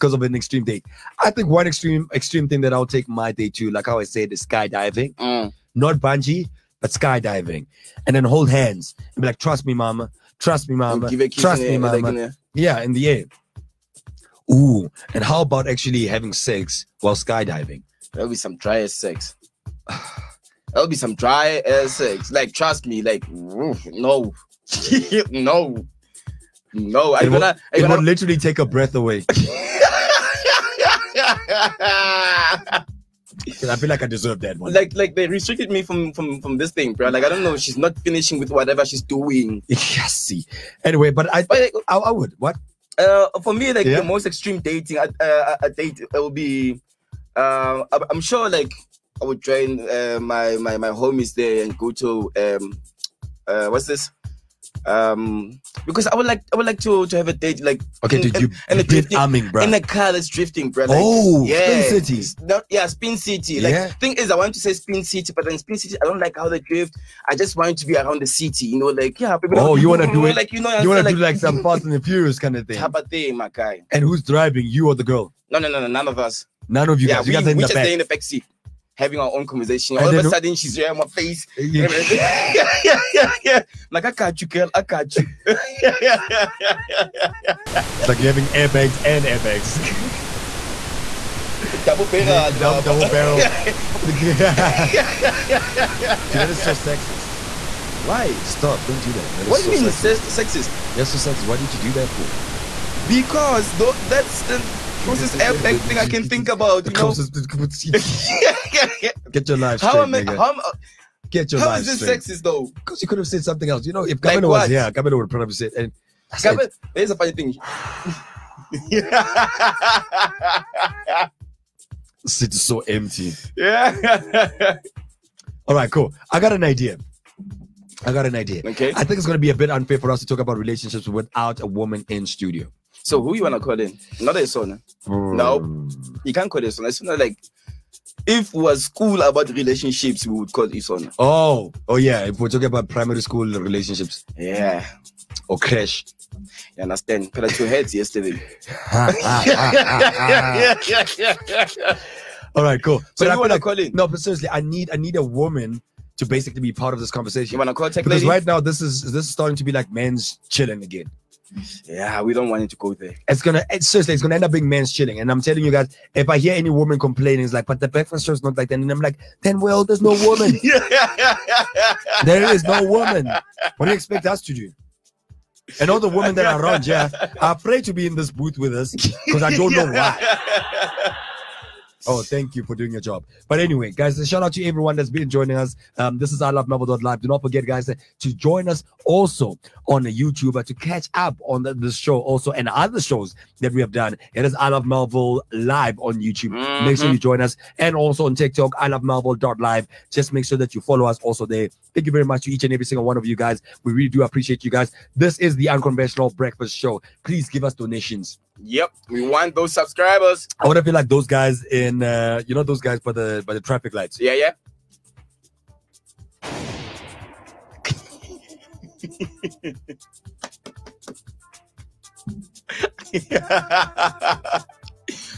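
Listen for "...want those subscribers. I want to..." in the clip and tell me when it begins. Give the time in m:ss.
3:29.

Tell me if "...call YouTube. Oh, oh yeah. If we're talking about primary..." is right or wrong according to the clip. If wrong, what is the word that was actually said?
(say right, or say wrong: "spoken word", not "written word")
wrong: "Ison", not "YouTube".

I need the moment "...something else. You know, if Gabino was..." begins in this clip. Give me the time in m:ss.
1:53.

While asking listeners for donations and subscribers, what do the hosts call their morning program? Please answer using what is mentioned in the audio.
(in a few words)
Unconventional Breakfast Show.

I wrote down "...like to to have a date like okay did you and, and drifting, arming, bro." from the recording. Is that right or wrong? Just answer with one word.
right.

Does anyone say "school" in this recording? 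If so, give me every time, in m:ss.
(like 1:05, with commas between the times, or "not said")
2:18, 2:23.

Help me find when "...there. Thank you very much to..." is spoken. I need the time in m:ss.
3:21.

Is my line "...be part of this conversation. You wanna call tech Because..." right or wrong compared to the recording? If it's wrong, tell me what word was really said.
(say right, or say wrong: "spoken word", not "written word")
right.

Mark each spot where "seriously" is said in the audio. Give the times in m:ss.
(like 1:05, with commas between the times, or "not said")
2:34, 2:43.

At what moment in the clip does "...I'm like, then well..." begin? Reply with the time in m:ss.
2:48.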